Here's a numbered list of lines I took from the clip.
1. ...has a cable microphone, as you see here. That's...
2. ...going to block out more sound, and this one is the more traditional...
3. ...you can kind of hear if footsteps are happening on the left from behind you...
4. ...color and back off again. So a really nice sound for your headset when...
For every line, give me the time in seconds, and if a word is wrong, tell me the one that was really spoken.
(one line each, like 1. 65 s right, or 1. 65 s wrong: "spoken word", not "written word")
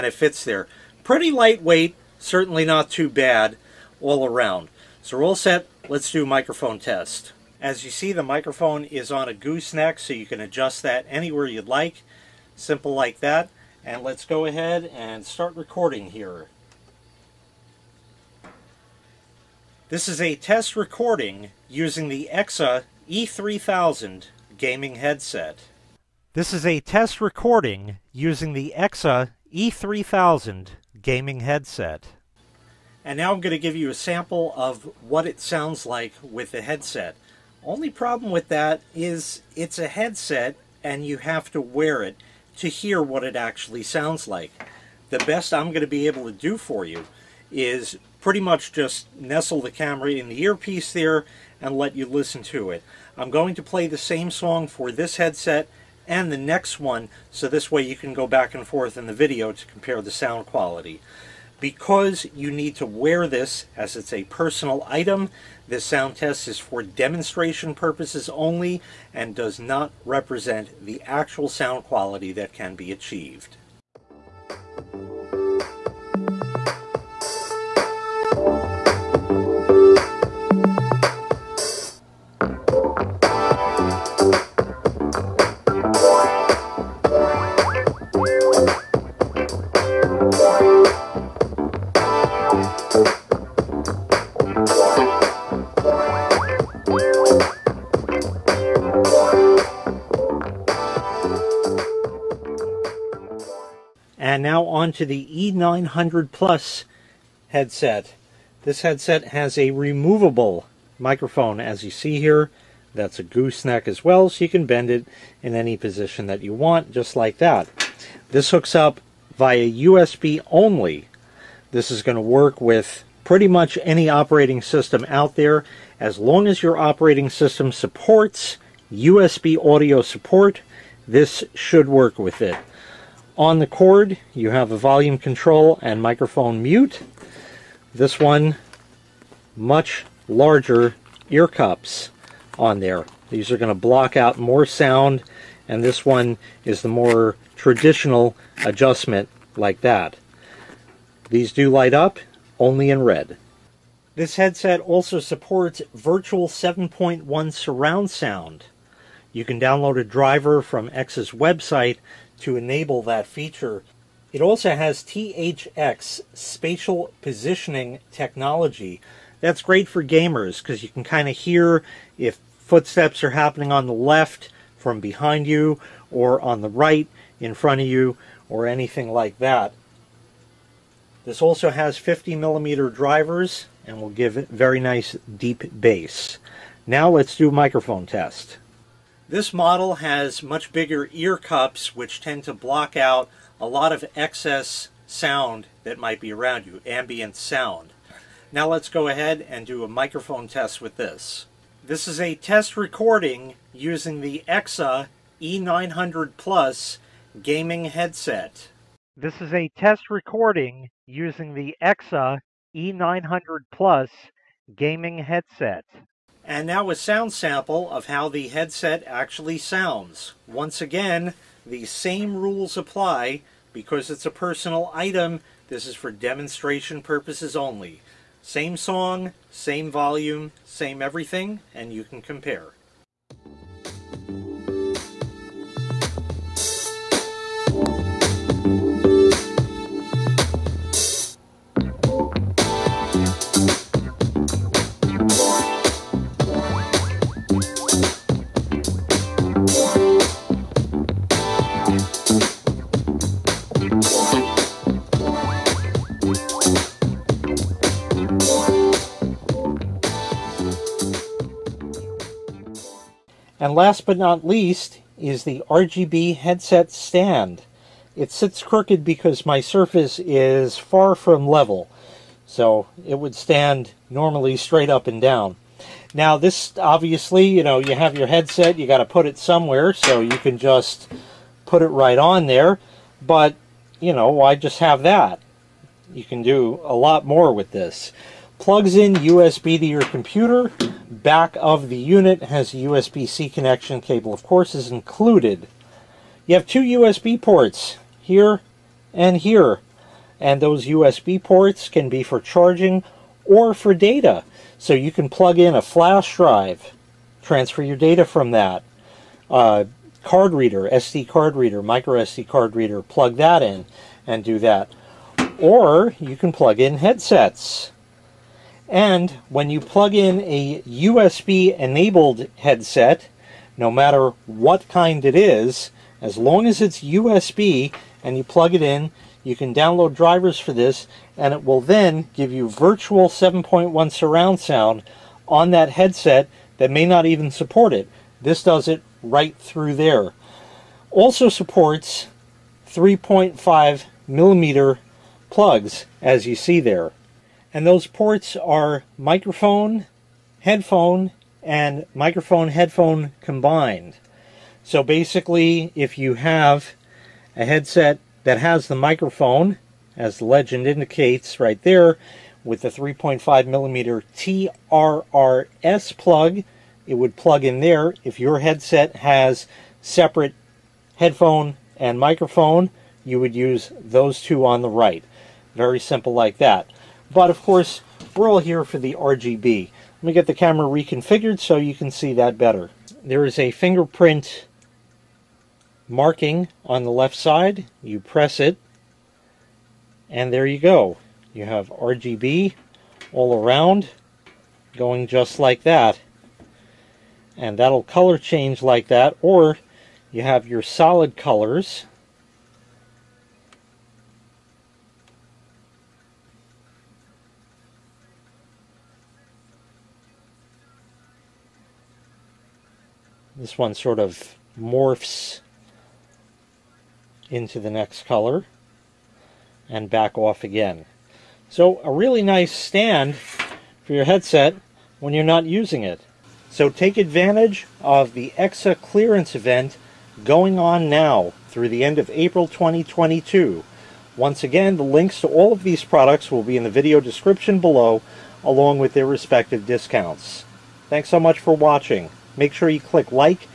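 1. 109 s wrong: "removable", not "cable"
2. 143 s right
3. 170 s right
4. 418 s wrong: "stand", not "sound".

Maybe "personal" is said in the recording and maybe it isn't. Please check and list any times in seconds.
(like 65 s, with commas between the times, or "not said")
64 s, 224 s.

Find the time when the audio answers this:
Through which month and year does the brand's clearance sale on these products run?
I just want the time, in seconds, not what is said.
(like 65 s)
432 s.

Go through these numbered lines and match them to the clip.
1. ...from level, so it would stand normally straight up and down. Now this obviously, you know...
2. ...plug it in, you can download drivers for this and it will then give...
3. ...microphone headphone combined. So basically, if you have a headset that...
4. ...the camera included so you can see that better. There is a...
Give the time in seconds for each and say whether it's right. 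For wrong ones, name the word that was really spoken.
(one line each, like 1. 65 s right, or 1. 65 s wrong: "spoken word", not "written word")
1. 271 s right
2. 328 s right
3. 352 s right
4. 380 s wrong: "reconfigured", not "included".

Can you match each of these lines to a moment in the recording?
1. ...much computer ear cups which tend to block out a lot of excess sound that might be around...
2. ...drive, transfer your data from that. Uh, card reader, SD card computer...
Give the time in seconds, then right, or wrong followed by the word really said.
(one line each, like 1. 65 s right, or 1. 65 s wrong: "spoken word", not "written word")
1. 190 s wrong: "bigger", not "computer"
2. 306 s wrong: "reader", not "computer".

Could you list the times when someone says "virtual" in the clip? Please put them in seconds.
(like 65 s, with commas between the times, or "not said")
155 s, 332 s.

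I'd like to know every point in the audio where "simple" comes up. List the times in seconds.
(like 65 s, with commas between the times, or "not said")
12 s, 375 s.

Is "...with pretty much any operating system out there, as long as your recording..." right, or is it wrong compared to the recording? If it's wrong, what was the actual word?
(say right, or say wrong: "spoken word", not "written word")
wrong: "operating", not "recording".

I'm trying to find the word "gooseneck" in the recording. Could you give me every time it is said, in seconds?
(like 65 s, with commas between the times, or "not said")
9 s, 113 s.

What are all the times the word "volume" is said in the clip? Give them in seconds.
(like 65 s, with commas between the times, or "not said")
134 s, 229 s.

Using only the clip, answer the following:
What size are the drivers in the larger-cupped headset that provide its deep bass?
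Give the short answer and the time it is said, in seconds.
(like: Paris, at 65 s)
50 millimeter, at 181 s.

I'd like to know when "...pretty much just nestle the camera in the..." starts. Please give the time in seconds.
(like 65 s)
48 s.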